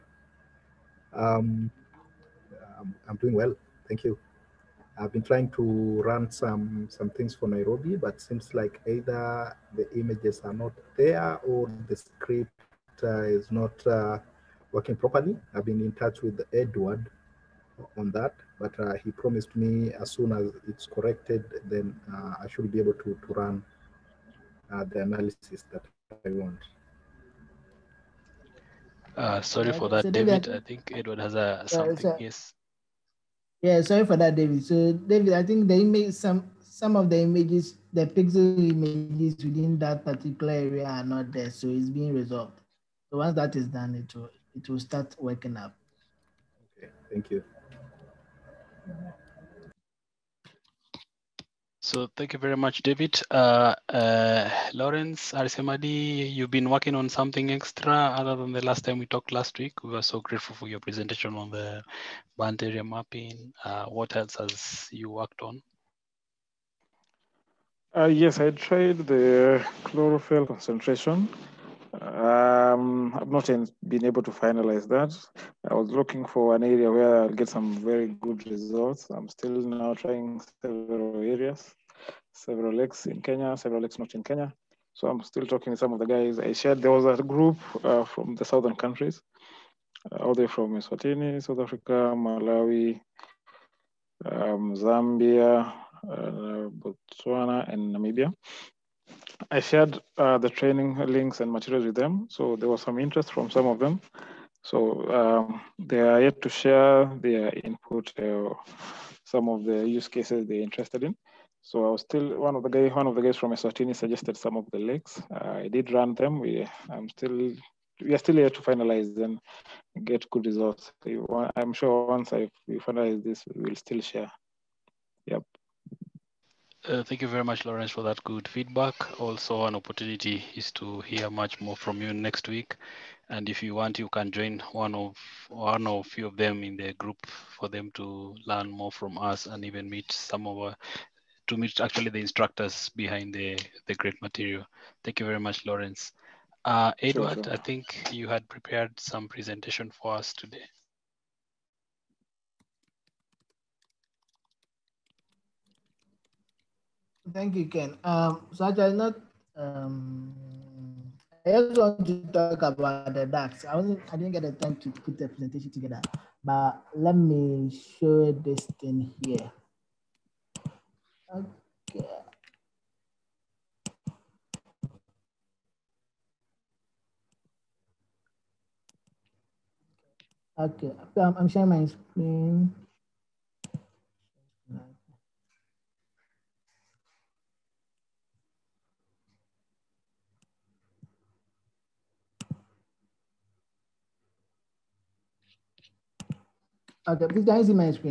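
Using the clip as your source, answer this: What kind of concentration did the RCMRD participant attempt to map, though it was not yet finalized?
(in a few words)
Chlorophyll.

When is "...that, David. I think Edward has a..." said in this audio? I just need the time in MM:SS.
00:29.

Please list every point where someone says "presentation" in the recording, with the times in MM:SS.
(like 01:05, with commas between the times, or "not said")
01:00, 02:29, 02:45.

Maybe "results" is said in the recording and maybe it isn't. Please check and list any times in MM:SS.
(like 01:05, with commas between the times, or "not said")
01:18, 02:00.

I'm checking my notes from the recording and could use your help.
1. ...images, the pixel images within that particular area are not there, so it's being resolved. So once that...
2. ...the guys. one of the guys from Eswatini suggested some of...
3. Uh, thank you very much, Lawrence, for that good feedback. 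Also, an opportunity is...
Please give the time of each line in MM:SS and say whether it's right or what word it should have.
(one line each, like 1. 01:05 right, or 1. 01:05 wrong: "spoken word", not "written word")
1. 00:37 right
2. 01:52 right
3. 02:06 right.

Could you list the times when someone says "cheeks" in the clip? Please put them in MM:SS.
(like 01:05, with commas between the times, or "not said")
not said.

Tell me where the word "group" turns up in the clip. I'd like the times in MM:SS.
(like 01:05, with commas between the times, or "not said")
01:27, 02:16.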